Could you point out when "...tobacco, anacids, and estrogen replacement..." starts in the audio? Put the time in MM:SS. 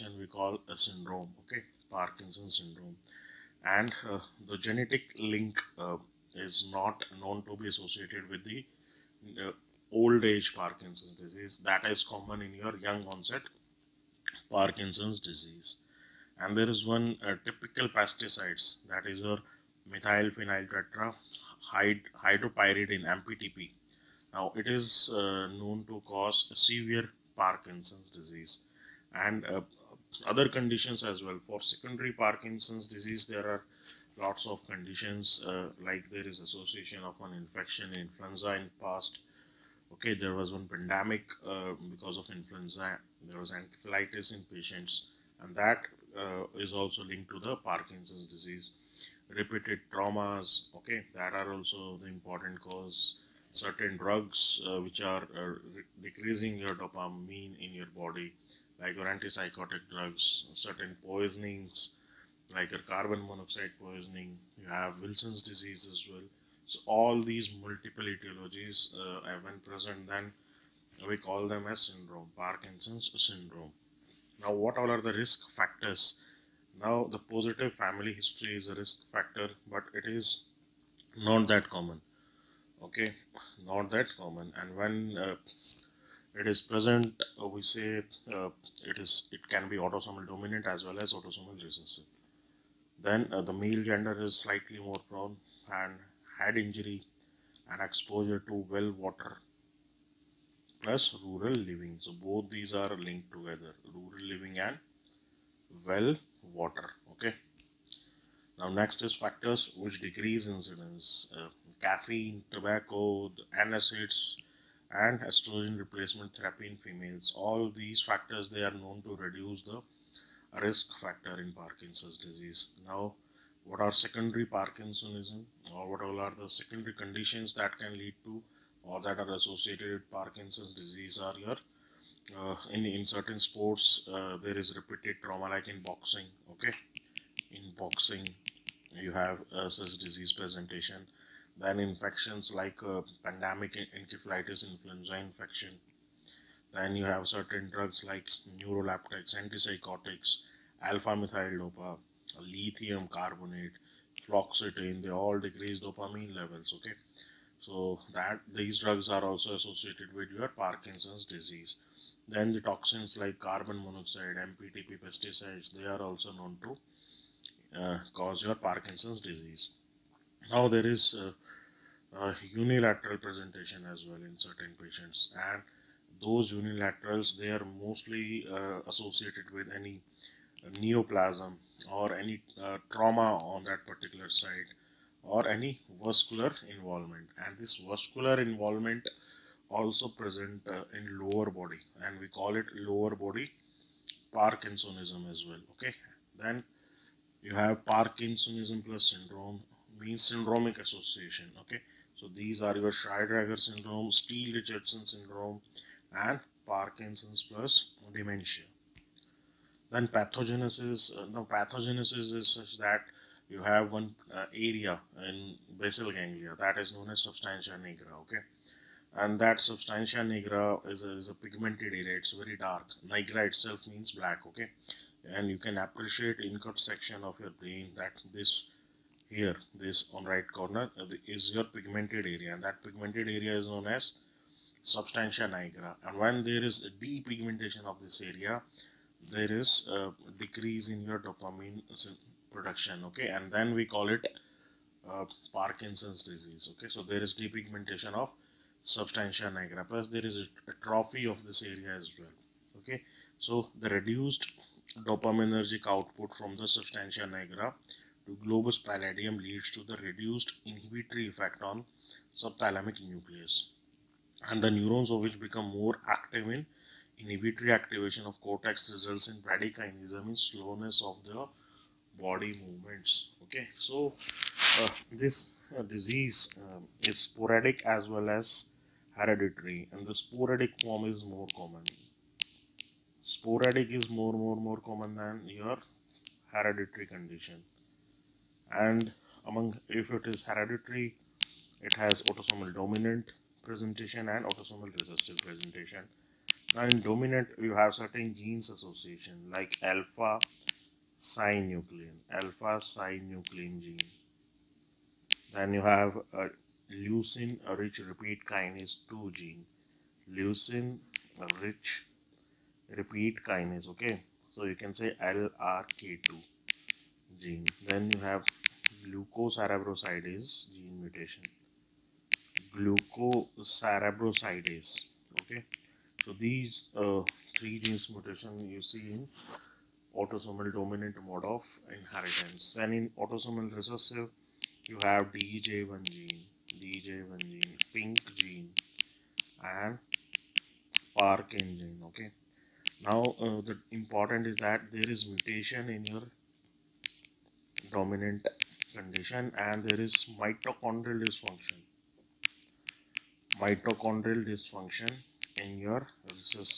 01:52.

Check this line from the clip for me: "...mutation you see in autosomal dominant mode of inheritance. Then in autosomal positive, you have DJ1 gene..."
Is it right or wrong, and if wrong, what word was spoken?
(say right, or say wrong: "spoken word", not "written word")
wrong: "recessive", not "positive".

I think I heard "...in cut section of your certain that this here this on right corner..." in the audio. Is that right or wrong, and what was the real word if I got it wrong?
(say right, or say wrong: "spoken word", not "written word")
wrong: "brain", not "certain".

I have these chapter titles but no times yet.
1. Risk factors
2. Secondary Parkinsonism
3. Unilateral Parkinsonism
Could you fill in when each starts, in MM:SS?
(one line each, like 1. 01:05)
1. 01:10
2. 02:03
3. 02:49.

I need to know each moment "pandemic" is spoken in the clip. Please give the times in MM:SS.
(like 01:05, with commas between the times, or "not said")
00:40, 02:23.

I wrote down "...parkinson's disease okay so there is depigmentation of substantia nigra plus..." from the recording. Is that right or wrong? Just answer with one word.
right.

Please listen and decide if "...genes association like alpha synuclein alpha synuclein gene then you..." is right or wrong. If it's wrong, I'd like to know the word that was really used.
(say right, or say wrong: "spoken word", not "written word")
right.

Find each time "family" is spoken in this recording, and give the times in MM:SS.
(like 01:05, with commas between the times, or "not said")
01:17.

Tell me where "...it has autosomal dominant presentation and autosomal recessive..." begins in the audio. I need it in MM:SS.
04:51.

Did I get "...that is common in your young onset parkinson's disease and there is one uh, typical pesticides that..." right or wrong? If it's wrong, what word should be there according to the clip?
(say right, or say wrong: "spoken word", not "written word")
right.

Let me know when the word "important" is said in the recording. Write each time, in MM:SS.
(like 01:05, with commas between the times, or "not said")
00:52, 05:43.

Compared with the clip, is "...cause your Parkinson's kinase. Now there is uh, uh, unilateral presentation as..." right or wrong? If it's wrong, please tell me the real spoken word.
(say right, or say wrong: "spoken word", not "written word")
wrong: "disease", not "kinase".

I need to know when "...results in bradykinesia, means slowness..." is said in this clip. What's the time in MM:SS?
04:28.